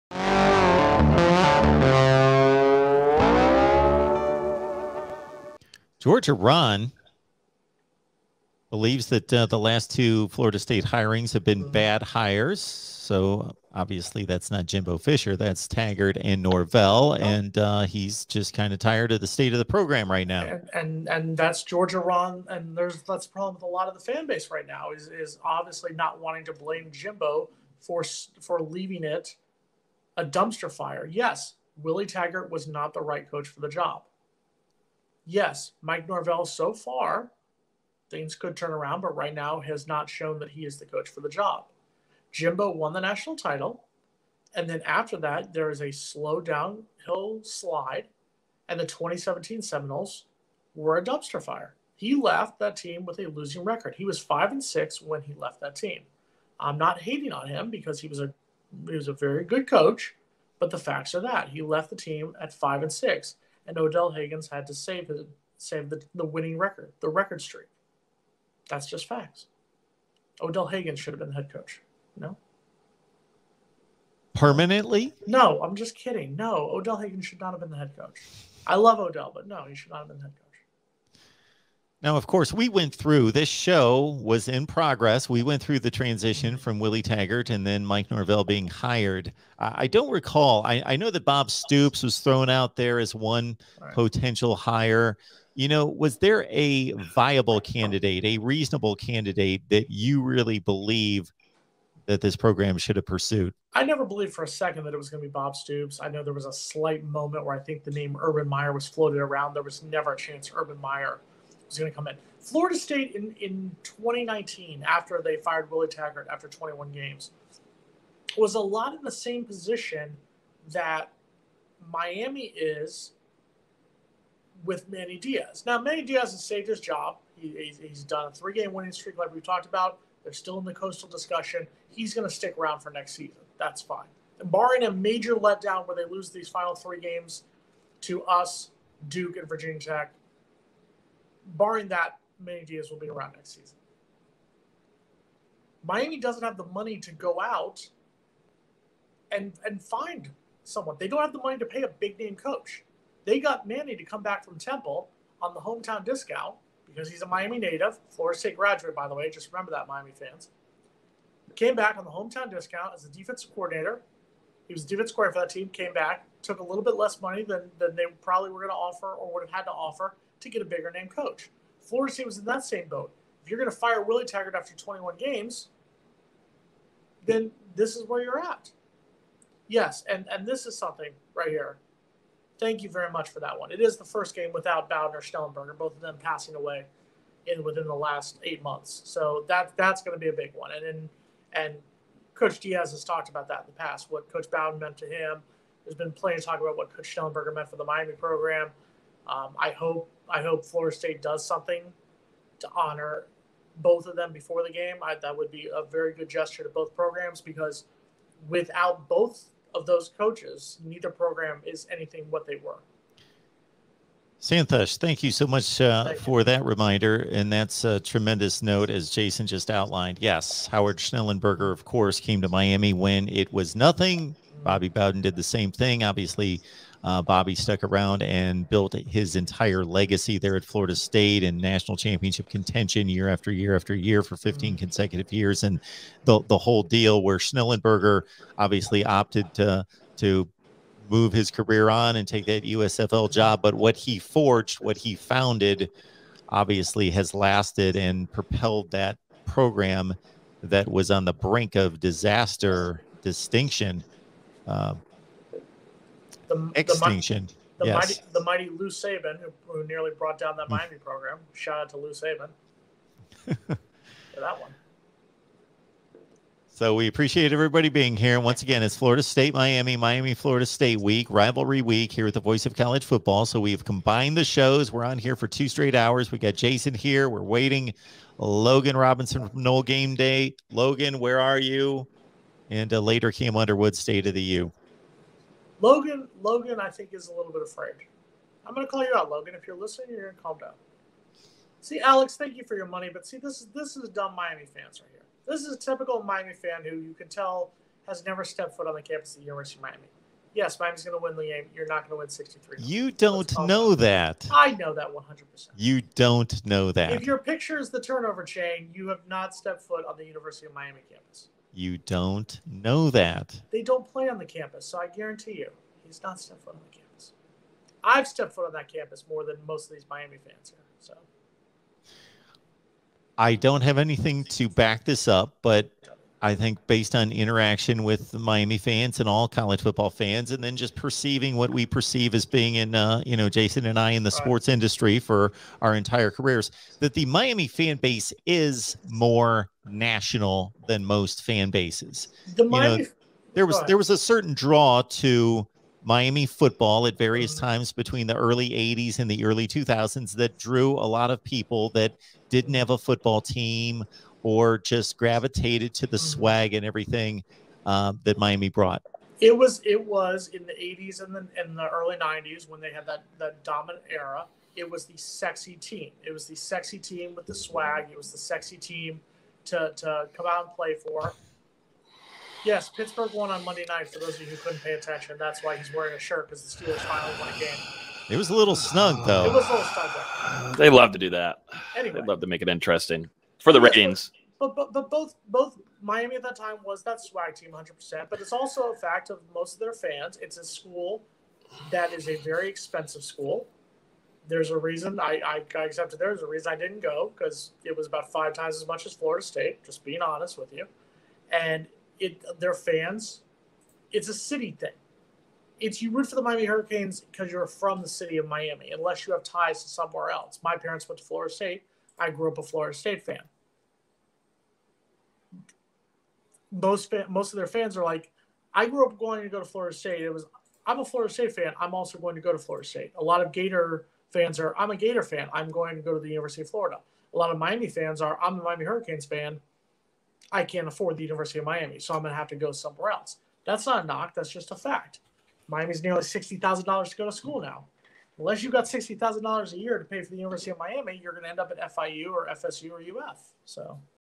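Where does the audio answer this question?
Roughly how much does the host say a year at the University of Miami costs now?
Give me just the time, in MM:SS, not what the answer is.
07:16.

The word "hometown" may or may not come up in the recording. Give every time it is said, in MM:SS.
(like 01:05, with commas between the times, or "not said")
02:35, 02:42.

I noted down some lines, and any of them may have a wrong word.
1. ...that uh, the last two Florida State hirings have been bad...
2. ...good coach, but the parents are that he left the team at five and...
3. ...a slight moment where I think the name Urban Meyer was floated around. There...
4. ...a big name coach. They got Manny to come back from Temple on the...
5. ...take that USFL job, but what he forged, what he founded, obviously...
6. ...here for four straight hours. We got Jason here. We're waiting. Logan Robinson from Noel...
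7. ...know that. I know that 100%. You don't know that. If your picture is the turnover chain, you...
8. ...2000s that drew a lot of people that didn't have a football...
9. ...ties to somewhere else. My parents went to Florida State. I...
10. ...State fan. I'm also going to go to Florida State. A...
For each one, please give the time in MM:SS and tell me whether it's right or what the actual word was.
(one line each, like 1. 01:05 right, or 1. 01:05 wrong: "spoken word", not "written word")
1. 00:09 right
2. 00:59 wrong: "facts", not "parents"
3. 01:46 right
4. 02:31 right
5. 04:02 right
6. 04:35 wrong: "two", not "four"
7. 05:03 right
8. 05:49 right
9. 06:49 right
10. 07:01 right.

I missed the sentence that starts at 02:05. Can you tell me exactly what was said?
Now, Manny Diaz has saved his job.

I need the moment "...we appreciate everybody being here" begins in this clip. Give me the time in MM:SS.
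04:26.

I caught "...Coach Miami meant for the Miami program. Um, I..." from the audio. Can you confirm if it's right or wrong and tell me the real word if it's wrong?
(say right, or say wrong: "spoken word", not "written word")
wrong: "Schnellenberger", not "Miami".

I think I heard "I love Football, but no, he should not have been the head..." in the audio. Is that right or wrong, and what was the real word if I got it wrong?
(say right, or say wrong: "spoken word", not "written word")
wrong: "Odell", not "Football".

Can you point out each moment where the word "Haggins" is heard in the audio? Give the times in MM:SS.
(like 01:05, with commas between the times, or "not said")
01:04, 01:10, 01:16.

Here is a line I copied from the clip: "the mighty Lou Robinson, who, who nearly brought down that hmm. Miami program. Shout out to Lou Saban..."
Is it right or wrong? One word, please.
wrong.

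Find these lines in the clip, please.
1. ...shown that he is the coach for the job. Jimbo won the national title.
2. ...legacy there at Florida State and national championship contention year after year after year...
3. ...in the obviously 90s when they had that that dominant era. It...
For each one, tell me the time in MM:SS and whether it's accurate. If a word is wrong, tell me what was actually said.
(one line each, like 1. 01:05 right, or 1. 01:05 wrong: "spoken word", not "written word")
1. 00:40 right
2. 03:49 right
3. 06:01 wrong: "early", not "obviously".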